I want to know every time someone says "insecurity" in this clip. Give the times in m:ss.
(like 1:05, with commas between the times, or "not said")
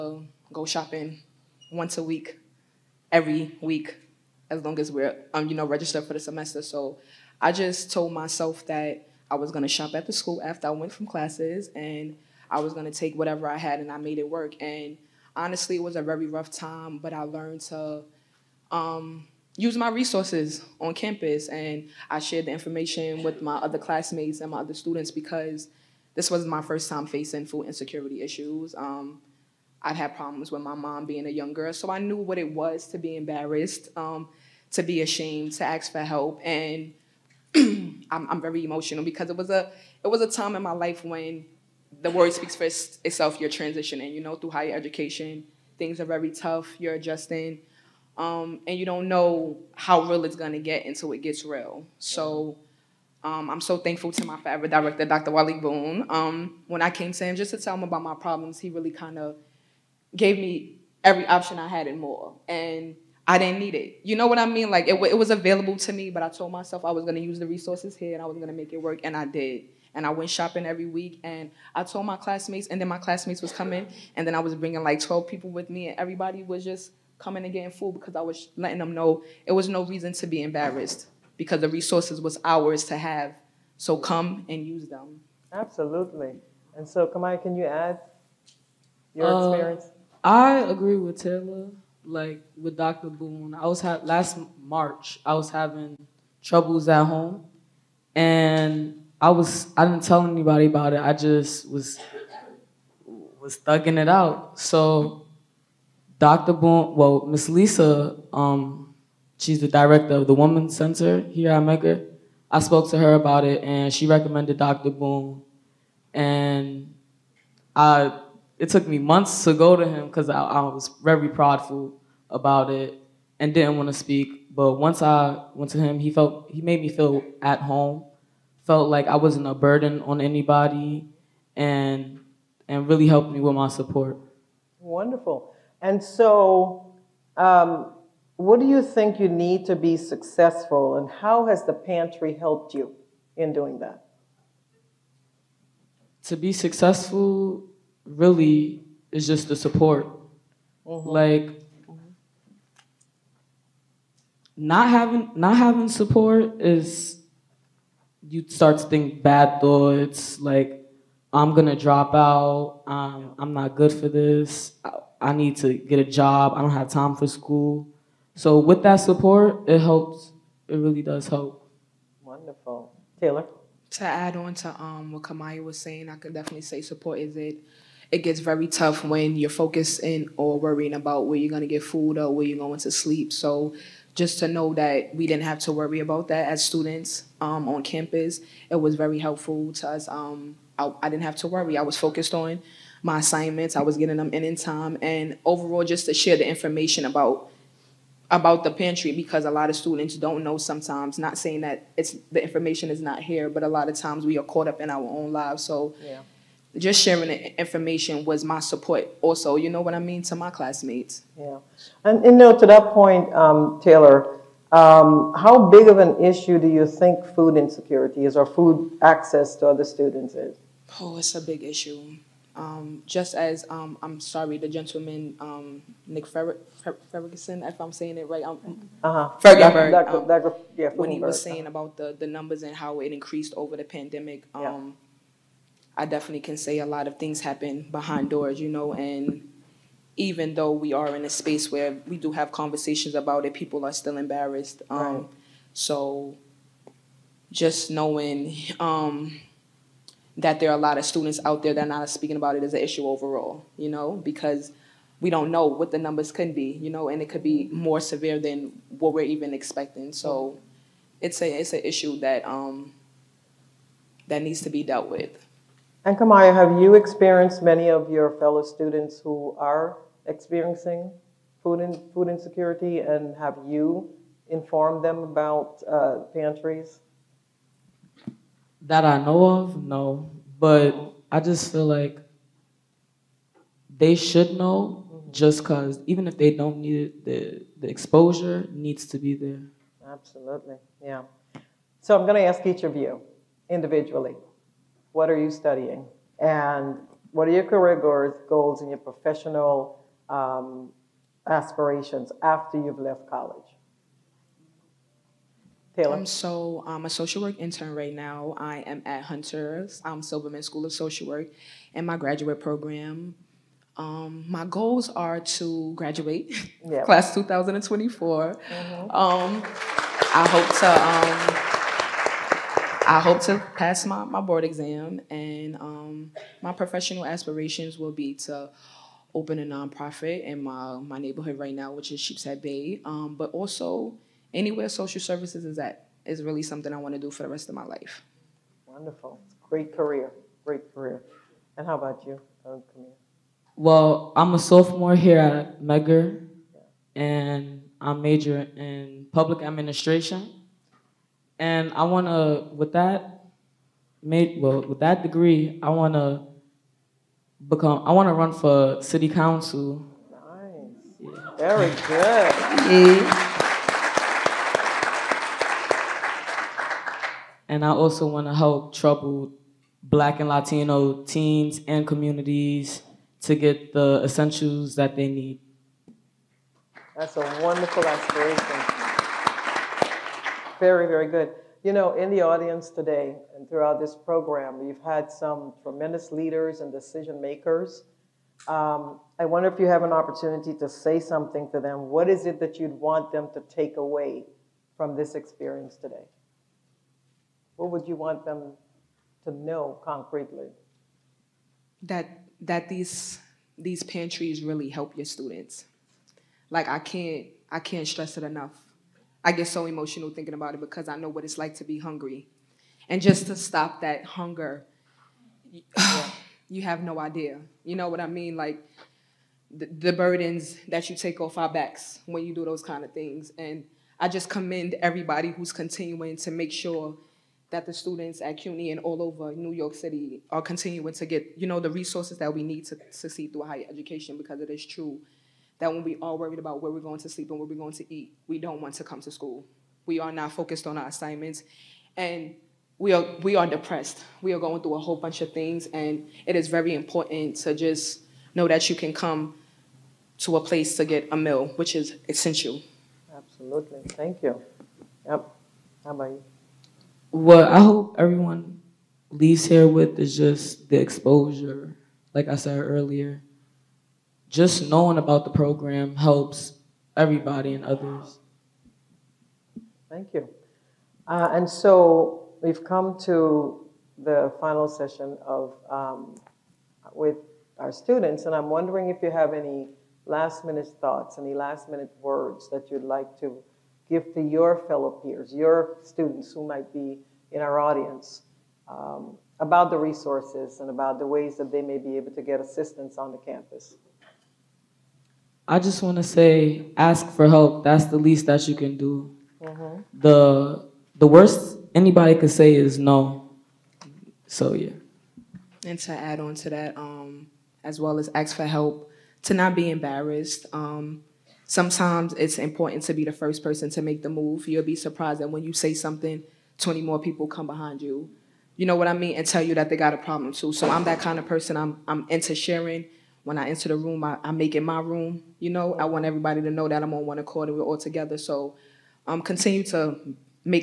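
0:27, 3:37, 4:32.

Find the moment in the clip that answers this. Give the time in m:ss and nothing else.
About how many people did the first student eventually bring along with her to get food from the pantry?
1:14.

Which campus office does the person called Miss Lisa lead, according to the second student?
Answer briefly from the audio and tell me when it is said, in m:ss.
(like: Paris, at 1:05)
Women's Center, at 1:50.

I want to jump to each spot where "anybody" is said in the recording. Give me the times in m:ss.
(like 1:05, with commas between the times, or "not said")
1:40, 2:10, 8:22.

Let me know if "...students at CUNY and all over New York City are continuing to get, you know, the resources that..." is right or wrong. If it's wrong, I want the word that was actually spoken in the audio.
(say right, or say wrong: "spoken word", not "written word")
right.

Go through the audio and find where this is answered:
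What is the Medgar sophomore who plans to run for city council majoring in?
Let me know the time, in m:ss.
5:49.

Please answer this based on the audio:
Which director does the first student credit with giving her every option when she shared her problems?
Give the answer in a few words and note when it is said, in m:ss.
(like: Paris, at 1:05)
Dr. Wally Boone, at 0:55.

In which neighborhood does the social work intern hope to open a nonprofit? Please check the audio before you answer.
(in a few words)
Sheepshead Bay.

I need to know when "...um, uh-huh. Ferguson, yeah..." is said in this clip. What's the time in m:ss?
3:48.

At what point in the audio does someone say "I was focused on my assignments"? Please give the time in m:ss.
3:11.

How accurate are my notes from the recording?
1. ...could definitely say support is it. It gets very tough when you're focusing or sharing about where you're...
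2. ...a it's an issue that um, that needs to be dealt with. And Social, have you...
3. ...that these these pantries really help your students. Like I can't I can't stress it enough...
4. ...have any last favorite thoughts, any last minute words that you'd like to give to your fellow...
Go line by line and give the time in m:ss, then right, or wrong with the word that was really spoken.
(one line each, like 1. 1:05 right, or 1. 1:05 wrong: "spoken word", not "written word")
1. 2:56 wrong: "worrying", not "sharing"
2. 4:21 wrong: "Camaya", not "Social"
3. 6:42 right
4. 7:59 wrong: "minute", not "favorite".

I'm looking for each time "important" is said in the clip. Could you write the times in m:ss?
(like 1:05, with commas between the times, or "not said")
7:26, 8:32.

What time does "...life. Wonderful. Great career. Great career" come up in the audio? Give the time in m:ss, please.
5:37.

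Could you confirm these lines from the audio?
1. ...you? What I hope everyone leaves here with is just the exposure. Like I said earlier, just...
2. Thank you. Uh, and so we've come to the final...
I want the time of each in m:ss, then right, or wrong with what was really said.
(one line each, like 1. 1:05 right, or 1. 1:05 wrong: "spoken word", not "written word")
1. 7:36 right
2. 7:50 right.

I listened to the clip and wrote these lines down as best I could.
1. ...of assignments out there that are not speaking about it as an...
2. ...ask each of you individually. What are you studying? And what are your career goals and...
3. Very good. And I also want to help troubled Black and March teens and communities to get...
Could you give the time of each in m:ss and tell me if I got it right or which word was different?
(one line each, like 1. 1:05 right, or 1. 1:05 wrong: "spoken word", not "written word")
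1. 4:10 wrong: "students", not "assignments"
2. 4:52 right
3. 6:01 wrong: "Latino", not "March".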